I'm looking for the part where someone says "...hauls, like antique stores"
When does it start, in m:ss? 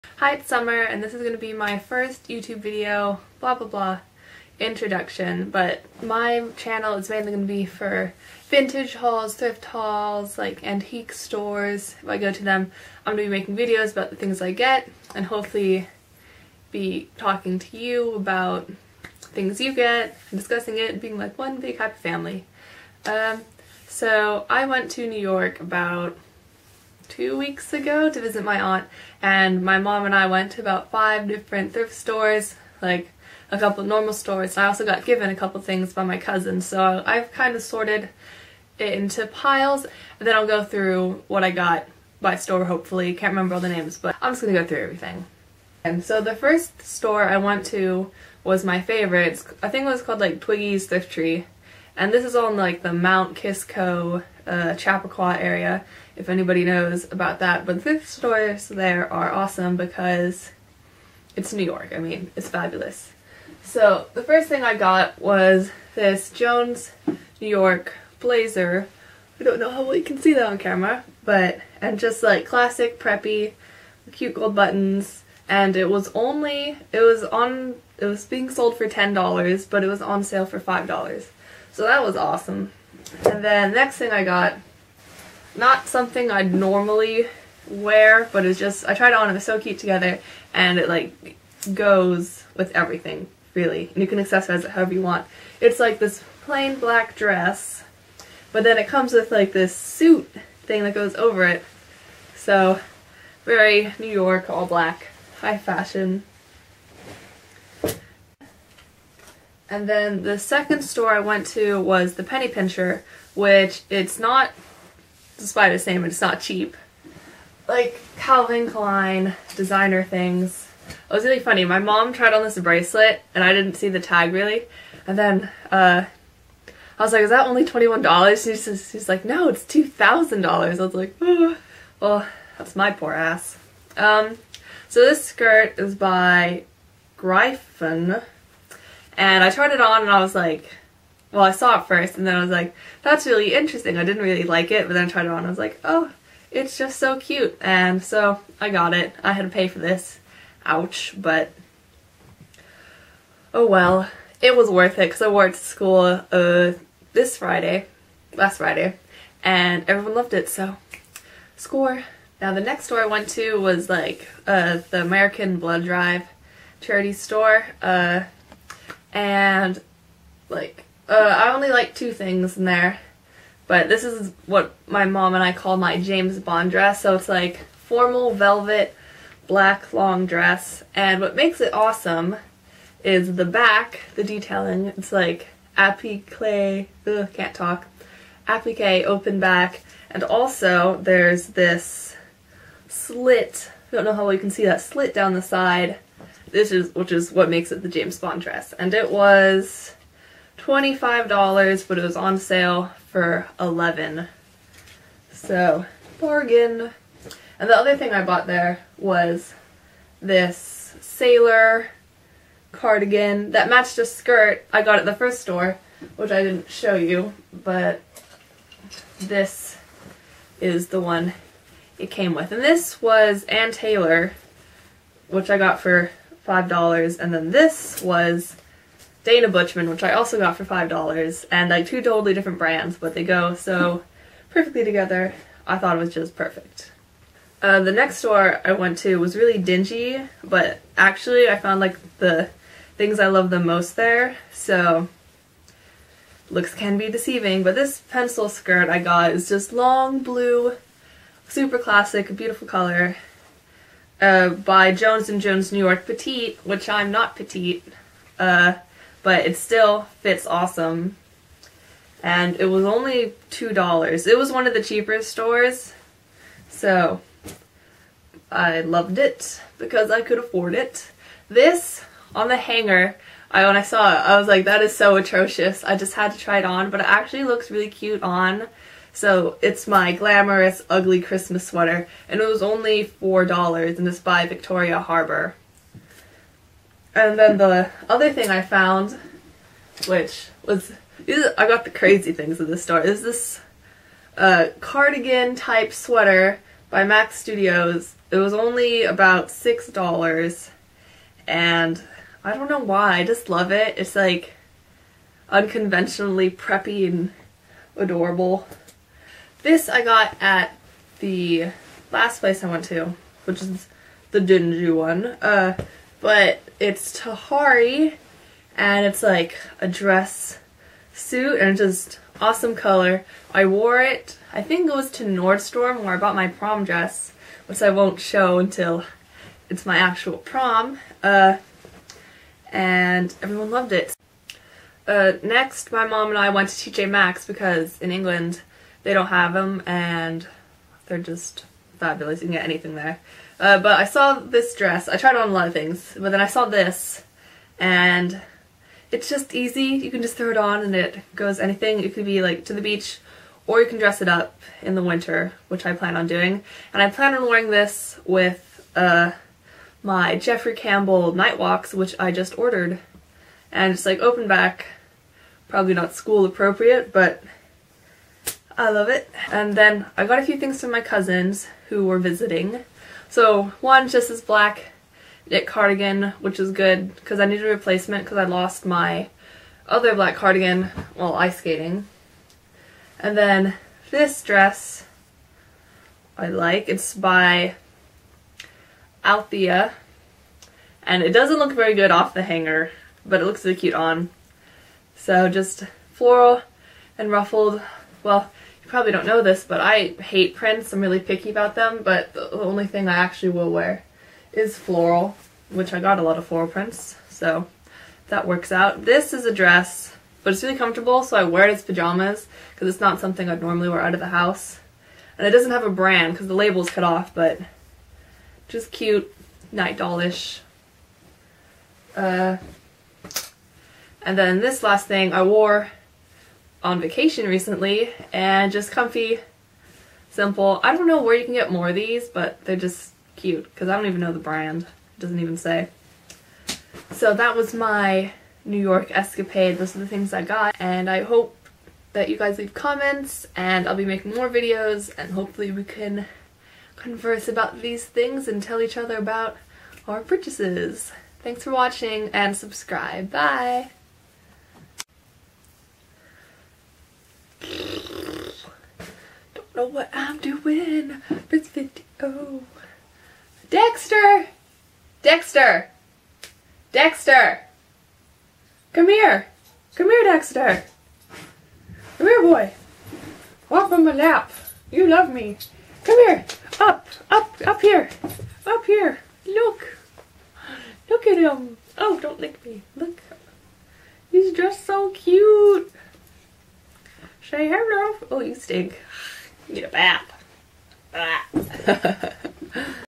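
0:09.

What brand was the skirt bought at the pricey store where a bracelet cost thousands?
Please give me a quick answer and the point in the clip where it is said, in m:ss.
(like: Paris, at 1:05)
Gryphon, at 2:17.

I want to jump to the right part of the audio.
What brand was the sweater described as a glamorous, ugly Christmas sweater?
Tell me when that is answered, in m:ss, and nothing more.
4:44.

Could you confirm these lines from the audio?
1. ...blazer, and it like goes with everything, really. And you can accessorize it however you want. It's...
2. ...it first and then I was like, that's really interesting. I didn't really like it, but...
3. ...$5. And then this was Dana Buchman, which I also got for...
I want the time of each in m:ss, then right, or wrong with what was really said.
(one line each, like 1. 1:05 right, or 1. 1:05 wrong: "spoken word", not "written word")
1. 1:29 wrong: "together", not "blazer"
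2. 2:21 right
3. 3:46 right.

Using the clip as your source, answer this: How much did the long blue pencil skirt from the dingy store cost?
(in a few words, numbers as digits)
$2.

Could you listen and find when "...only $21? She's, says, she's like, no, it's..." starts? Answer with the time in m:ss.
2:07.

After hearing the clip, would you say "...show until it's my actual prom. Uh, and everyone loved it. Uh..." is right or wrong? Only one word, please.
right.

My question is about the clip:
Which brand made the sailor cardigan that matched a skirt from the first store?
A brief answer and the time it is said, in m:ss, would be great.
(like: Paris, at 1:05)
Ann Taylor, at 3:43.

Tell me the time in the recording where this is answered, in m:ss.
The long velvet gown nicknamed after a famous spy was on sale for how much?
3:22.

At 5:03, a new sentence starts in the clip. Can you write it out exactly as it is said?
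It's like unconventionally preppy and adorable.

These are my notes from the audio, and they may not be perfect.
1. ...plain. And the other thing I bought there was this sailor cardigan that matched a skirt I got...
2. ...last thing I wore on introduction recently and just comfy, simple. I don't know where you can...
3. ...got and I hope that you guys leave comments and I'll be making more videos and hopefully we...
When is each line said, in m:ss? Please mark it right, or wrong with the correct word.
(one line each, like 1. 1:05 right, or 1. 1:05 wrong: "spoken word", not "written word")
1. 3:26 wrong: "bargain", not "plain"
2. 7:04 wrong: "vacation", not "introduction"
3. 7:20 right.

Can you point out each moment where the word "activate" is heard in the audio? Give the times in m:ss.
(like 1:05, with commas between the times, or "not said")
not said.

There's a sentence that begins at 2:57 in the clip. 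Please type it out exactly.
So it's like formal velvet black long dress, and what makes it awesome is the back, the detailing.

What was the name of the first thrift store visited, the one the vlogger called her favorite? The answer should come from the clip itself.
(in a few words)
Twiggy's Thrift Tree.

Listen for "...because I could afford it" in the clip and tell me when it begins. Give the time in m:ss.
4:29.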